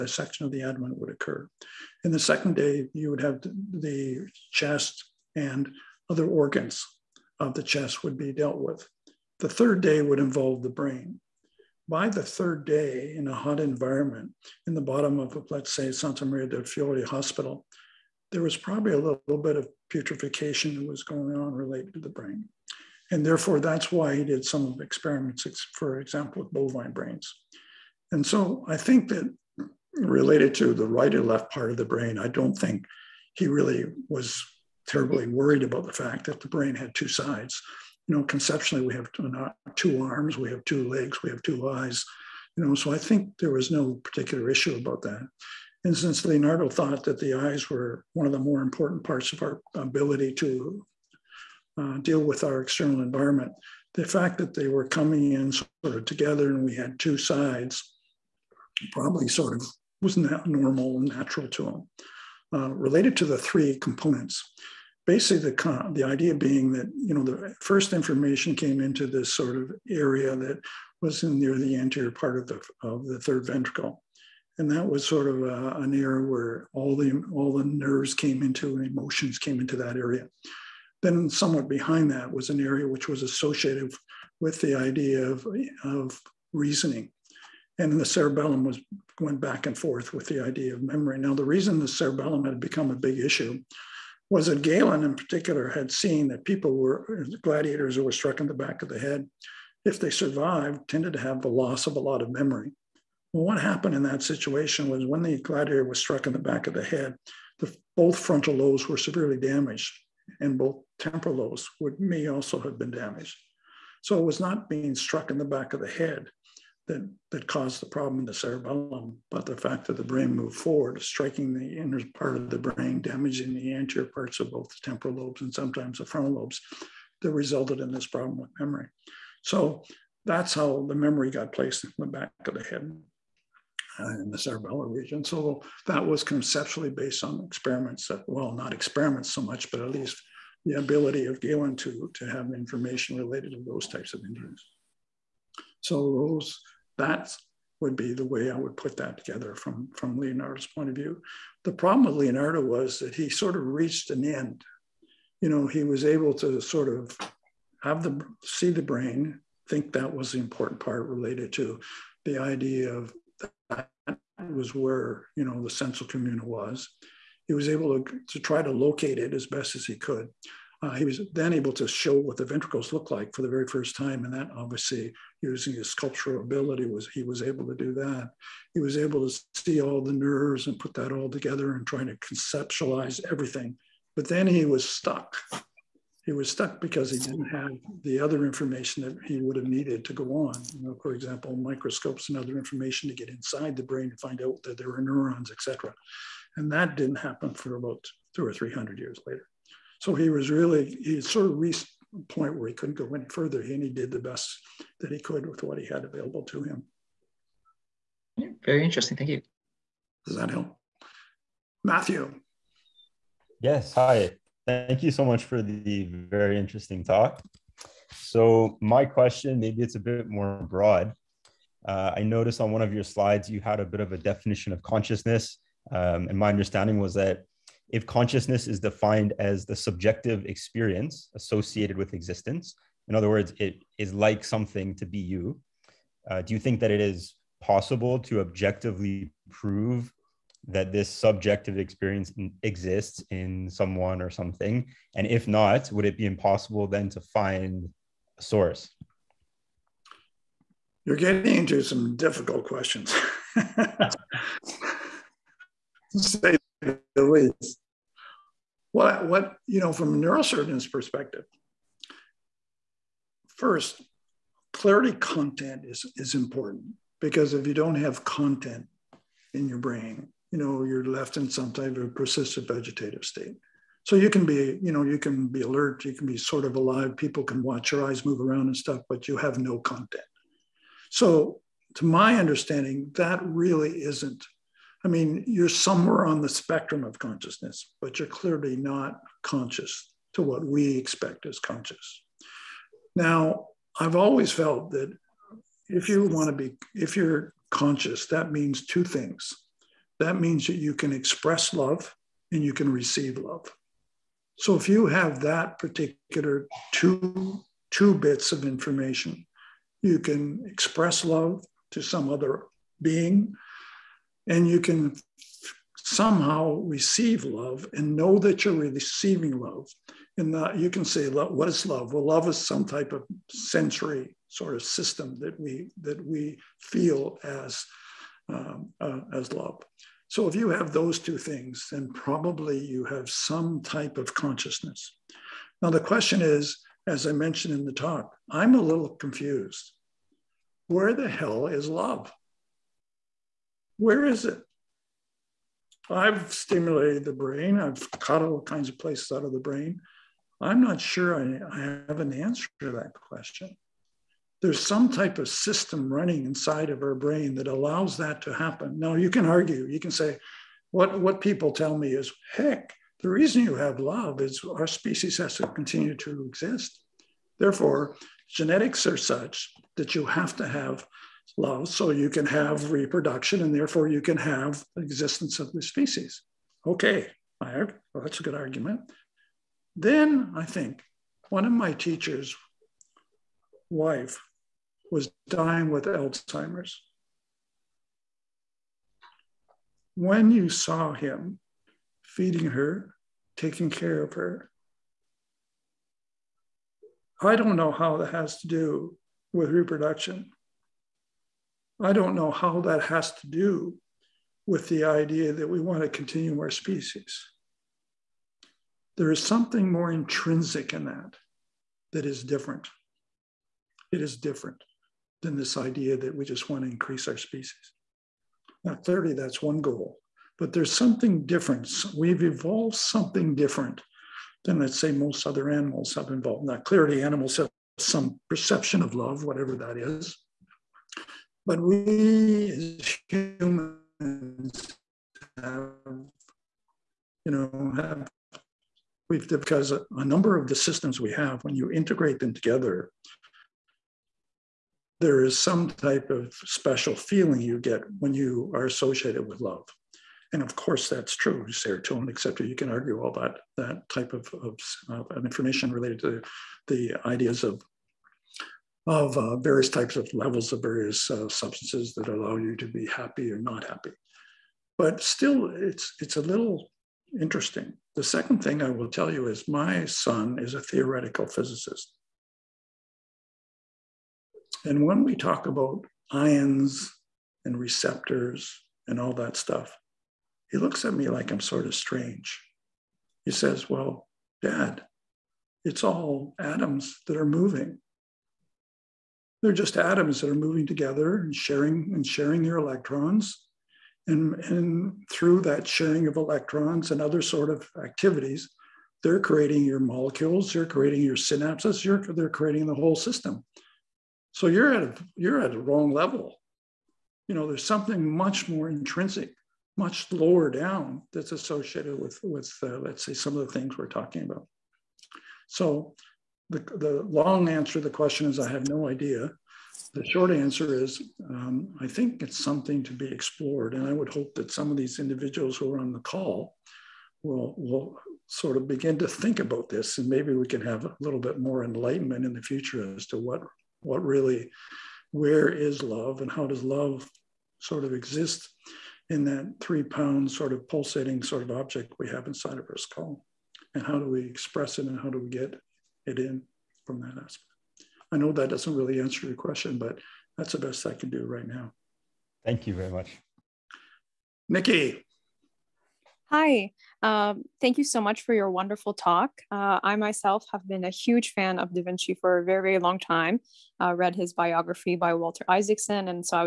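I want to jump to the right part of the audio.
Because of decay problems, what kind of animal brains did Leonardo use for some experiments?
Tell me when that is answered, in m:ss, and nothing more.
0:26.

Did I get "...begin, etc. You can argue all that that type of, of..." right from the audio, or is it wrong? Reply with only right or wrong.
wrong.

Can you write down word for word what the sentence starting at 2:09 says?
So that's how the memory got placed in the back of the head uh, in the cerebellar region.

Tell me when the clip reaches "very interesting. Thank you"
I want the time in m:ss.
3:28.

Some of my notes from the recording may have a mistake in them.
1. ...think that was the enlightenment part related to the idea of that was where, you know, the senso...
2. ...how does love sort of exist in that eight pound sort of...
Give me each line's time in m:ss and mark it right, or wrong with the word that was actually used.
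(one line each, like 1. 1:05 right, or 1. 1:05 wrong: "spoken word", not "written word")
1. 2:39 wrong: "important", not "enlightenment"
2. 8:56 wrong: "three", not "eight".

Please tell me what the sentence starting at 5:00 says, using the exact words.
That means that you can express love and you can receive love.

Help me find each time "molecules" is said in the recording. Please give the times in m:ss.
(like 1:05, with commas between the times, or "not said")
8:20.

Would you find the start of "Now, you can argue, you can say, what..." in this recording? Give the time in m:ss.
5:58.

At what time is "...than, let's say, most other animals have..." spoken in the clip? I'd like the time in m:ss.
7:04.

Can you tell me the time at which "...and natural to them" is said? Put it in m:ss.
1:00.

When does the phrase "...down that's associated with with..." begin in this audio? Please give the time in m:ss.
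8:30.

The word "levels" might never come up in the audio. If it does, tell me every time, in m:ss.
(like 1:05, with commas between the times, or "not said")
7:40, 8:26.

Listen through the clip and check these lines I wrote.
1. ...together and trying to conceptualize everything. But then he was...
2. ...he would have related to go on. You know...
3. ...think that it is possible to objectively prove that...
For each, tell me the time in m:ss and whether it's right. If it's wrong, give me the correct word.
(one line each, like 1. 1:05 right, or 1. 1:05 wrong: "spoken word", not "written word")
1. 3:01 right
2. 3:09 wrong: "needed", not "related"
3. 3:56 right.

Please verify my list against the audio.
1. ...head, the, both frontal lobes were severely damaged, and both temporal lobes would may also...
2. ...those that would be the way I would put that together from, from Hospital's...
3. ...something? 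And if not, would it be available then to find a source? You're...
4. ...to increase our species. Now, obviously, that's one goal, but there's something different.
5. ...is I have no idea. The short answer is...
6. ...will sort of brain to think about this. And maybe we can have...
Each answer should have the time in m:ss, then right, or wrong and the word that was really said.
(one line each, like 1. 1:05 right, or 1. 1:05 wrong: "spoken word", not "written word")
1. 1:46 right
2. 2:26 wrong: "Leonardo", not "Hospital"
3. 4:04 wrong: "impossible", not "available"
4. 6:56 wrong: "clearly", not "obviously"
5. 8:38 right
6. 8:47 wrong: "begin", not "brain".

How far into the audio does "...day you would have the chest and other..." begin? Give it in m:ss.
0:02.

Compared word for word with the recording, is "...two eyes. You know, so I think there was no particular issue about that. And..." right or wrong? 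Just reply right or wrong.
right.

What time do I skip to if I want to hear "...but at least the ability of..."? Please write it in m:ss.
2:19.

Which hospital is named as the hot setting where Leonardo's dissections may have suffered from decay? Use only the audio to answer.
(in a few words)
Santa Maria del Fiore.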